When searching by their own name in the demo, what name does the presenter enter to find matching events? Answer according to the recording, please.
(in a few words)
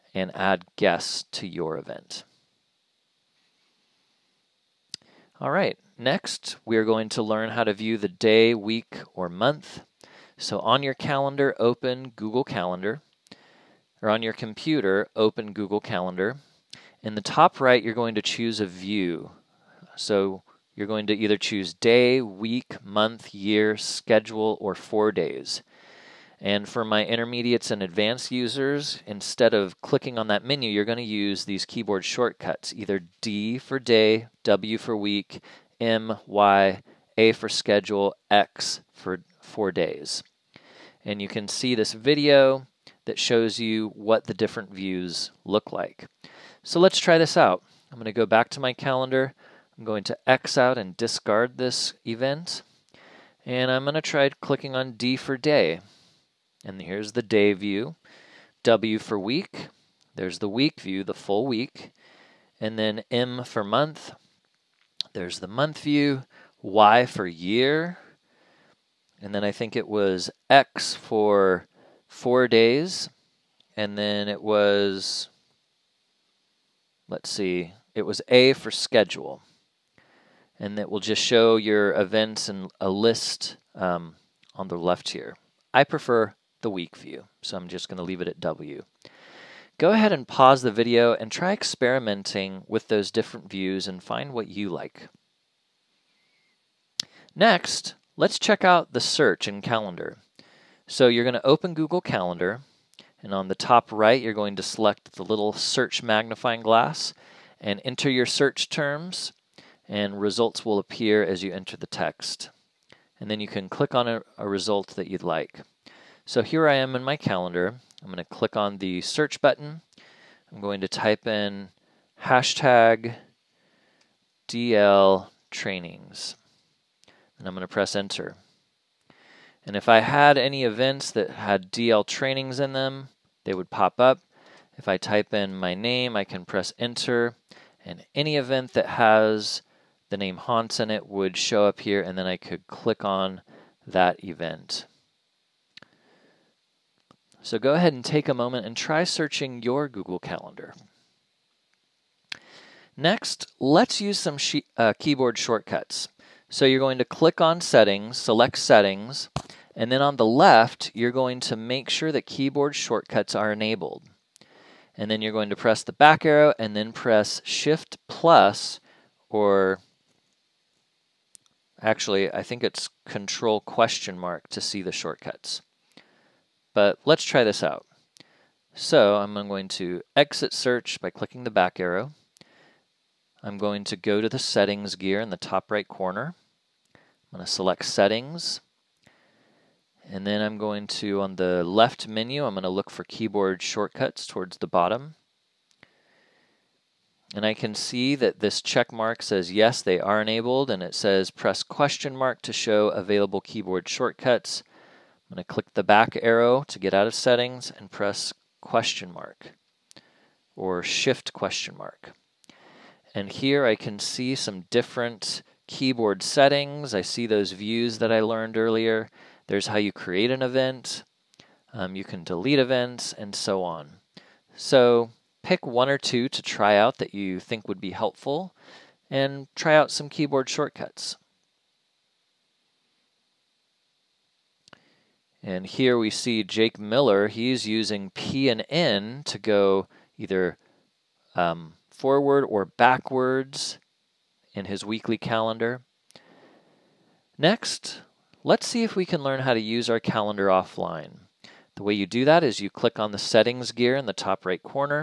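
Hans.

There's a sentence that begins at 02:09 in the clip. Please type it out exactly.
And if I had any events that had DL trainings in them, they would pop up.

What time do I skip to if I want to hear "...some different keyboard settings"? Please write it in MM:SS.
03:34.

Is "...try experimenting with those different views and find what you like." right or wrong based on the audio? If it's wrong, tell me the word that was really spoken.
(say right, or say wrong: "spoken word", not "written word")
right.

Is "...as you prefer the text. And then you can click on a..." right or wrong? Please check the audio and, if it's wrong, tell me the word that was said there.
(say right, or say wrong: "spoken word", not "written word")
wrong: "enter", not "prefer".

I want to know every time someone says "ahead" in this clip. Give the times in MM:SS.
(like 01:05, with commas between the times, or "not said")
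01:29, 02:27.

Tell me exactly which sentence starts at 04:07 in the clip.
Next, let's see if we can learn how to use our calendar offline.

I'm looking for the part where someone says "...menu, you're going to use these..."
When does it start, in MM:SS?
00:30.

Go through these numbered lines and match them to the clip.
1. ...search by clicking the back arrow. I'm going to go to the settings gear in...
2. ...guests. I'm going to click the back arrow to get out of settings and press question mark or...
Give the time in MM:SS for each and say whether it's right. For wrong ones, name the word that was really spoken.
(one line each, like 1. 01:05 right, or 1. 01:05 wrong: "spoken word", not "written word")
1. 03:00 right
2. 03:23 wrong: "shortcuts", not "guests".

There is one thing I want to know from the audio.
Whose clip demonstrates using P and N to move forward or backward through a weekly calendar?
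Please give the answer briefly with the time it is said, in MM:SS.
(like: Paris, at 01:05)
Jake Miller, at 03:56.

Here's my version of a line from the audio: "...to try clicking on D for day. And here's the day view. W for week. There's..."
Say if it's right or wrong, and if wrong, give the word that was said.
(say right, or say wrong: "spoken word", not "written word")
right.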